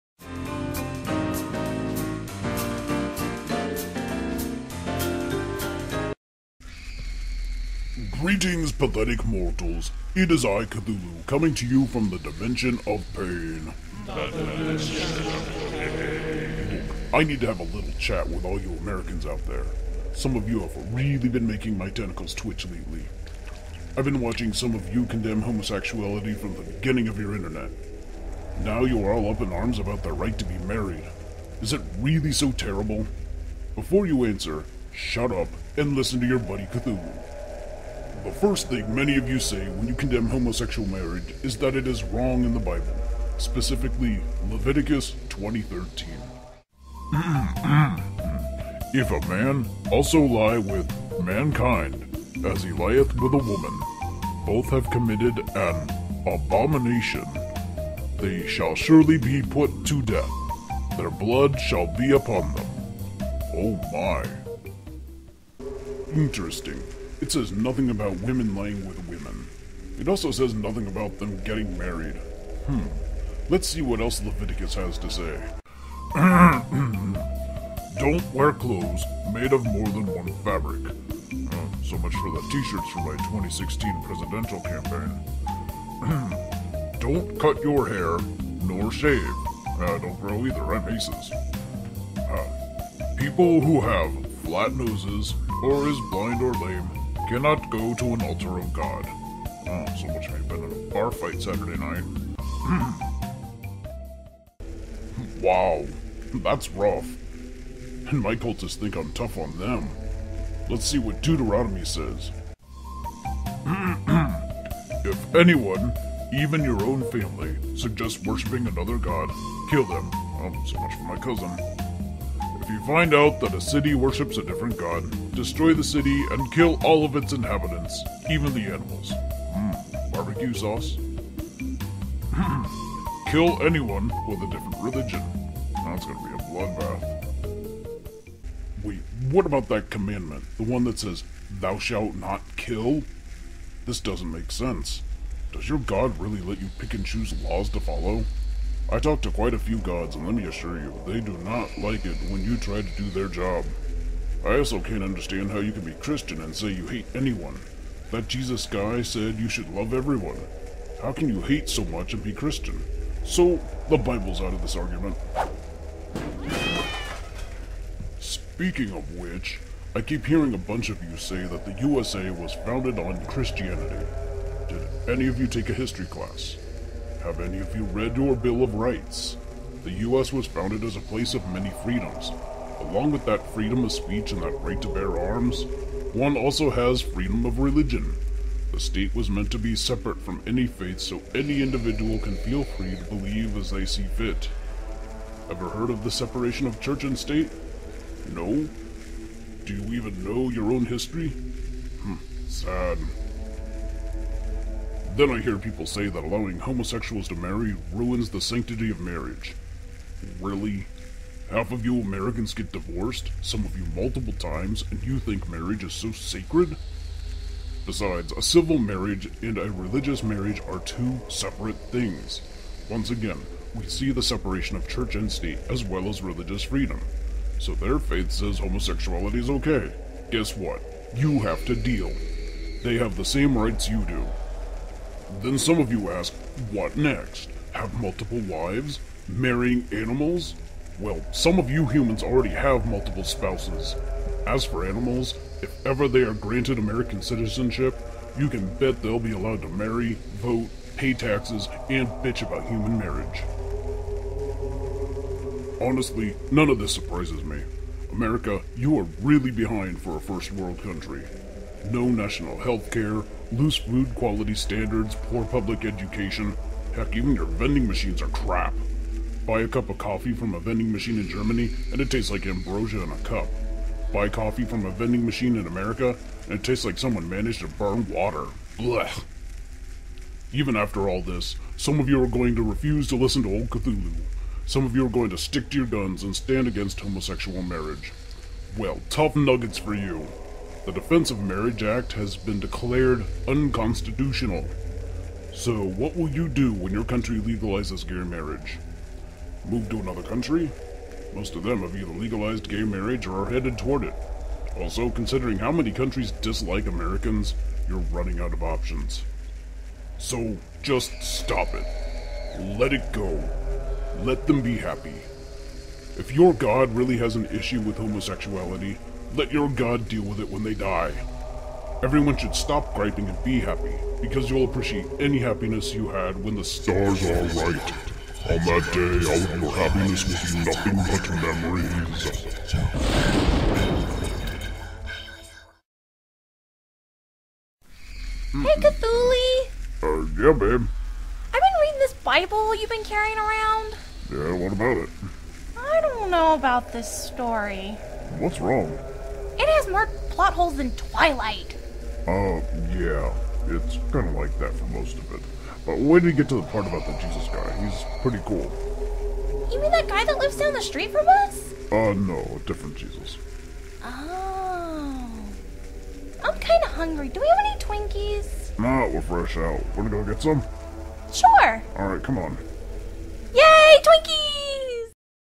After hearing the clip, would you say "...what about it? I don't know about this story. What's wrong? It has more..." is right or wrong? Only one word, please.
right.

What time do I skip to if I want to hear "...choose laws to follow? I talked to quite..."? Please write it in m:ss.
2:27.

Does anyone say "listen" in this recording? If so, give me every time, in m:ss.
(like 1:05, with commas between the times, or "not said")
0:35, 4:43.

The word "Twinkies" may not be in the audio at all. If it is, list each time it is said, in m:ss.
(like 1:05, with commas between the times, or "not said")
6:07.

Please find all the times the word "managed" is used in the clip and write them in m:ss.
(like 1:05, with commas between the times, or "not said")
4:37.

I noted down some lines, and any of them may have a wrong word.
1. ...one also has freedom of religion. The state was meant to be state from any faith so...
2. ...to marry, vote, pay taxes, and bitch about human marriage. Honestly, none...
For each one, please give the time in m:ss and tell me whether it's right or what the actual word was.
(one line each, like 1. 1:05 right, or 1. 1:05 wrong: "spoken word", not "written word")
1. 3:06 wrong: "separate", not "state"
2. 4:09 right.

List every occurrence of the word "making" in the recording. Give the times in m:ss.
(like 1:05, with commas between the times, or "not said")
0:21.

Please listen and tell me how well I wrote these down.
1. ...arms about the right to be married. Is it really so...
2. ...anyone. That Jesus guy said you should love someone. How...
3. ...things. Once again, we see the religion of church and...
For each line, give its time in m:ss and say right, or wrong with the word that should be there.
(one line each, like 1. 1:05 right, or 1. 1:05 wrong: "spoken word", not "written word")
1. 0:29 right
2. 2:37 wrong: "everyone", not "someone"
3. 3:41 wrong: "separation", not "religion".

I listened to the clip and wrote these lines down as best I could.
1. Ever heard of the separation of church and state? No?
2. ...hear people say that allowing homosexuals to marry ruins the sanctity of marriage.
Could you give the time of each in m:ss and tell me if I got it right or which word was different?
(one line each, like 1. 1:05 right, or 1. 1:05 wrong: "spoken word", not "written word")
1. 3:15 right
2. 3:25 right.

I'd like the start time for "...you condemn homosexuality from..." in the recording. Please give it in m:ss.
0:24.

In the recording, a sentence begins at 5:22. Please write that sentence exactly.
Everyone should stop griping and be happy, because you'll appreciate any happiness you had when the stars are right.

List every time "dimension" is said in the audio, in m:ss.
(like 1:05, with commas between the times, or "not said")
0:12.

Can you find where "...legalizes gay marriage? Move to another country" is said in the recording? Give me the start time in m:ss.
4:57.